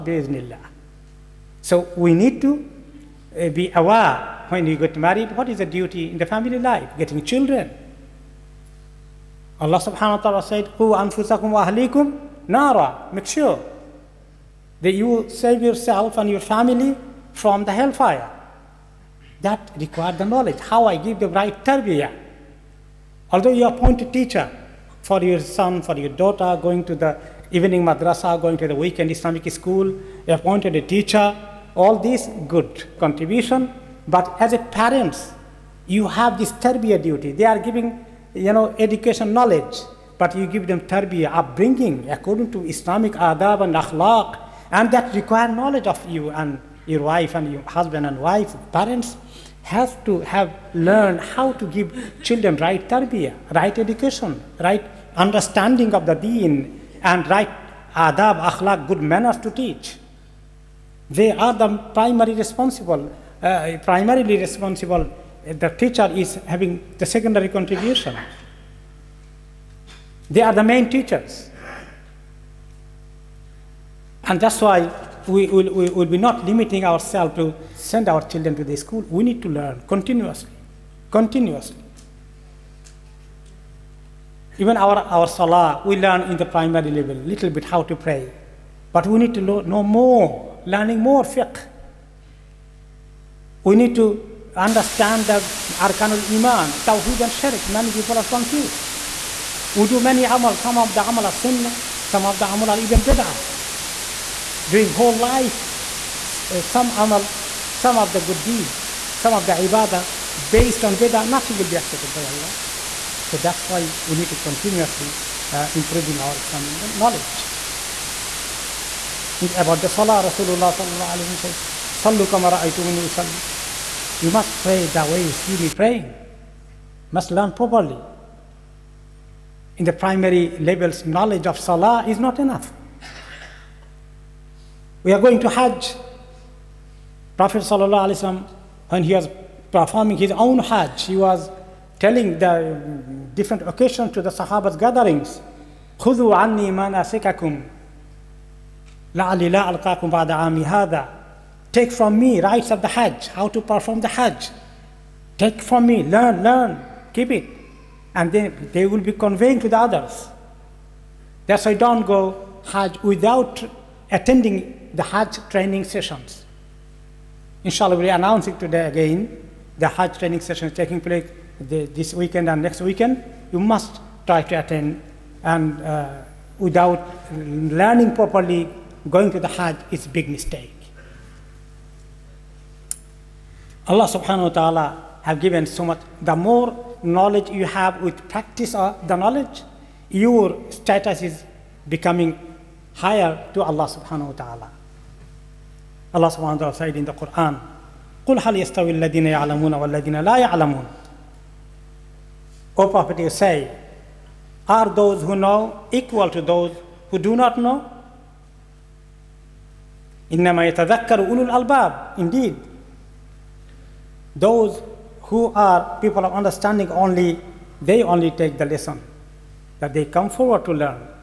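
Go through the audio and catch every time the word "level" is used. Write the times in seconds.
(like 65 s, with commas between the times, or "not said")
86 s, 130 s.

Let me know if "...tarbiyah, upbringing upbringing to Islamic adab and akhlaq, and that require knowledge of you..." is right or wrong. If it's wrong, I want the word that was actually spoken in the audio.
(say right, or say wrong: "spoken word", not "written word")
wrong: "according", not "upbringing".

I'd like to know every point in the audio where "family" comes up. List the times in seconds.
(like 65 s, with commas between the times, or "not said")
6 s, 16 s.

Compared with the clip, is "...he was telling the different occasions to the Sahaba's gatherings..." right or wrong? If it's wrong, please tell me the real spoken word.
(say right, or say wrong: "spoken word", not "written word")
right.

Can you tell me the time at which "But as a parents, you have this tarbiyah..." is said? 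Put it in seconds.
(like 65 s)
34 s.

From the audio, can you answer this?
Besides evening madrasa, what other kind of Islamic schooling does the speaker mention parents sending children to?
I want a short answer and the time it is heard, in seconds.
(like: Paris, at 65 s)
weekend Islamic school, at 28 s.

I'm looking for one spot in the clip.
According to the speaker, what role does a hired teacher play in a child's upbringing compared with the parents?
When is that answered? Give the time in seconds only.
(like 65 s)
67 s.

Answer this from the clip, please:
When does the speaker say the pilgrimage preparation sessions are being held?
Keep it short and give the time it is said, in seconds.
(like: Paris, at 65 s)
this weekend and next weekend, at 171 s.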